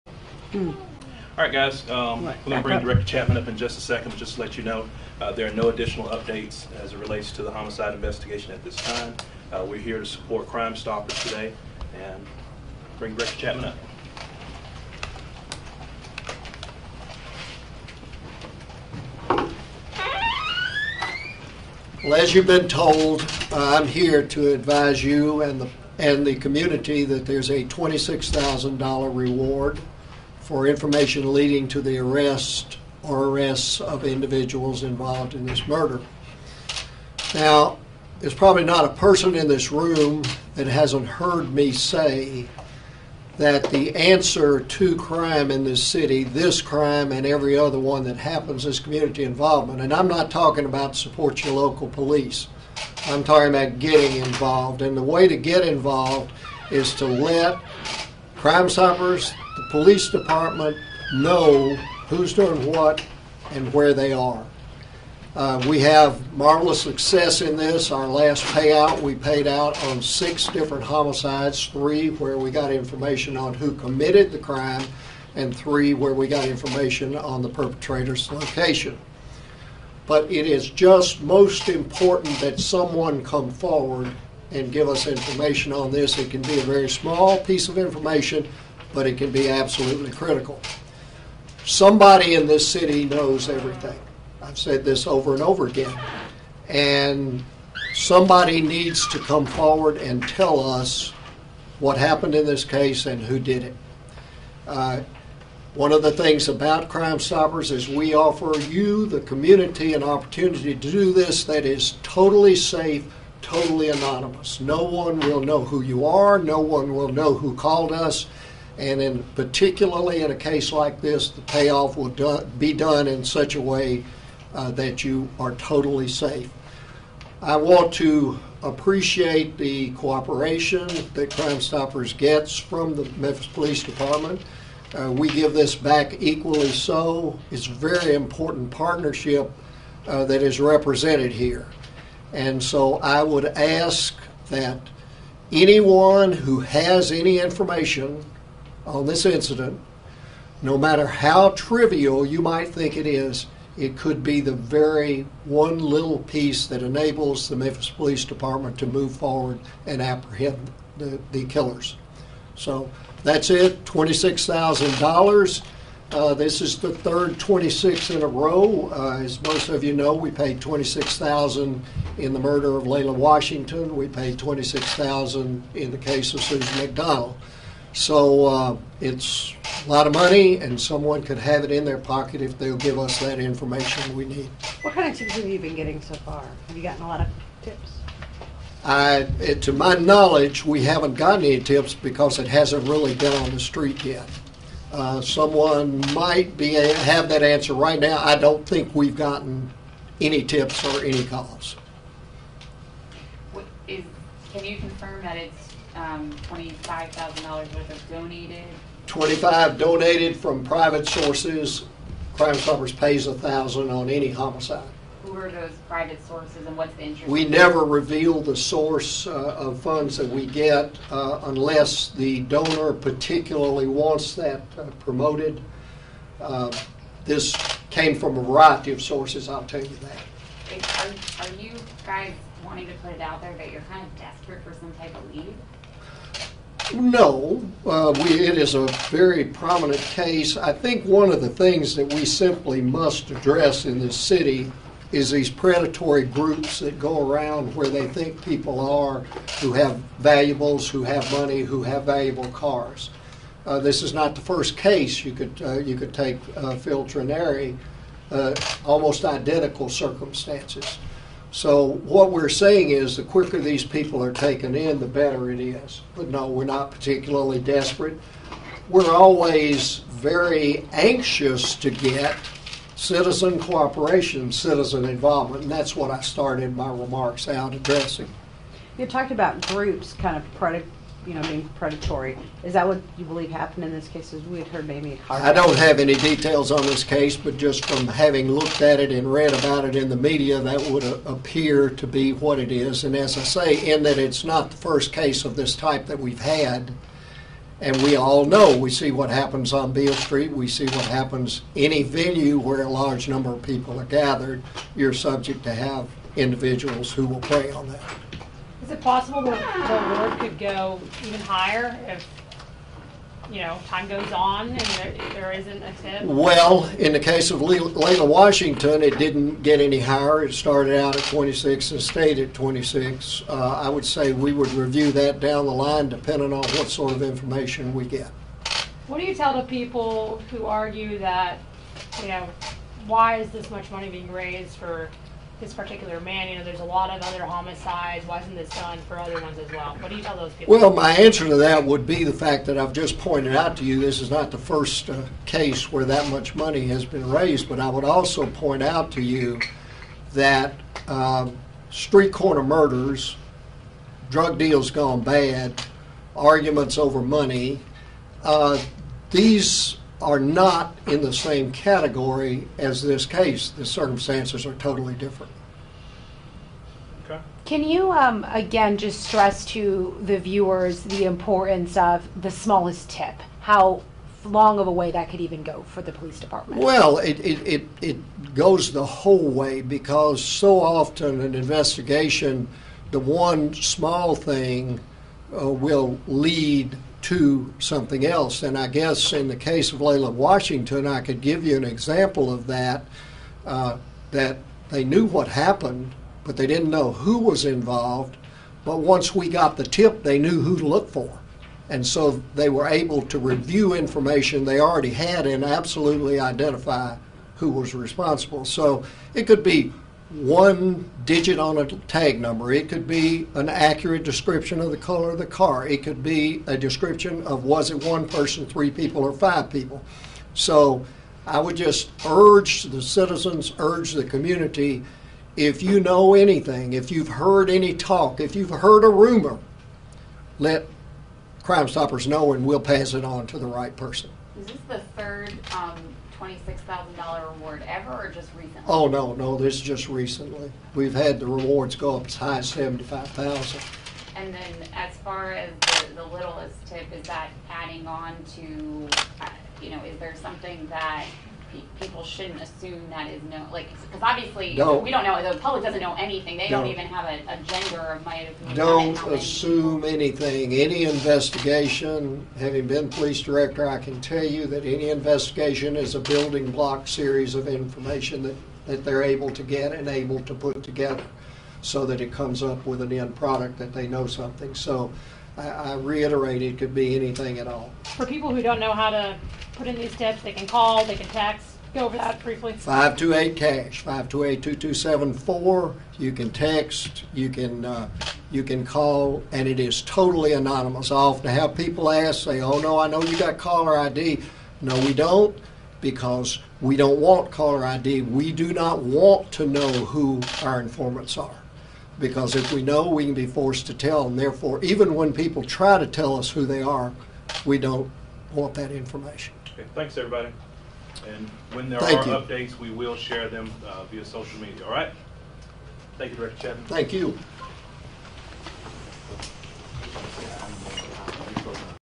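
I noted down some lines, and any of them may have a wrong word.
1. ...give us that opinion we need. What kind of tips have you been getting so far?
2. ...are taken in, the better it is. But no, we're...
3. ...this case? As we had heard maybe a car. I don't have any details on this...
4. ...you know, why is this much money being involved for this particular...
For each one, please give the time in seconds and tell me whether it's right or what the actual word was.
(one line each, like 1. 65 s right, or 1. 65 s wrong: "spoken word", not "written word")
1. 182 s wrong: "information", not "opinion"
2. 264 s right
3. 283 s right
4. 332 s wrong: "raised", not "involved".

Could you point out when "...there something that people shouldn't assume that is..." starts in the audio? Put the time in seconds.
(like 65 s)
450 s.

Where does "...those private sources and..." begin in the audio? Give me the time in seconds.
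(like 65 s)
215 s.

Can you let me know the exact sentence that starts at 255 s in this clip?
You could uh, you could take uh, Phil uh, almost identical circumstances.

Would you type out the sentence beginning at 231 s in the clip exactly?
Are, are you guys wanting to put it out there that you're kind of desperate for some type of lead?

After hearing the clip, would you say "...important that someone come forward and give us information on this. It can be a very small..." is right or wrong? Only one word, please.
right.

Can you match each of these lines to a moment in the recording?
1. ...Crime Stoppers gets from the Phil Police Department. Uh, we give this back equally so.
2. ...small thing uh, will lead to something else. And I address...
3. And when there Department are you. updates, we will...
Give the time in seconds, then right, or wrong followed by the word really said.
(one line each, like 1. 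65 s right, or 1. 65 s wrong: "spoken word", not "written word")
1. 131 s wrong: "Memphis", not "Phil"
2. 383 s wrong: "guess", not "address"
3. 511 s wrong: "Thank", not "Department".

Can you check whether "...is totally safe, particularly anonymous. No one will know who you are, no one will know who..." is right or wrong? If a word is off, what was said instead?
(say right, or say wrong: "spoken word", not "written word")
wrong: "totally", not "particularly".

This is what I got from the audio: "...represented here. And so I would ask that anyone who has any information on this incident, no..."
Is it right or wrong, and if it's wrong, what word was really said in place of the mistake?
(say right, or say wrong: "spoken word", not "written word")
right.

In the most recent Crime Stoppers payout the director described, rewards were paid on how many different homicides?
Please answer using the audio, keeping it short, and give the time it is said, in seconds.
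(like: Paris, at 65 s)
6, at 70 s.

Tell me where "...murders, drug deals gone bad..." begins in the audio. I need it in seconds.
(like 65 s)
352 s.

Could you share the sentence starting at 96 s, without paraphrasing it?
And somebody needs to come forward and tell us what happened in this case and who did it.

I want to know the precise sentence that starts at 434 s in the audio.
Is this the third um twenty-six thousand dollar reward ever, or just recently?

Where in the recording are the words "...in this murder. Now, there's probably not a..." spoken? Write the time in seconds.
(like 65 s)
35 s.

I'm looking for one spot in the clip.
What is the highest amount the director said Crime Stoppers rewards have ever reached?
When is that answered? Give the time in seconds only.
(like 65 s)
442 s.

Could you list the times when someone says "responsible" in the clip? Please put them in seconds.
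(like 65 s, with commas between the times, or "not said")
407 s.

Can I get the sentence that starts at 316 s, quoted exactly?
Well, in the case of Layla Washington, it didn't get any higher.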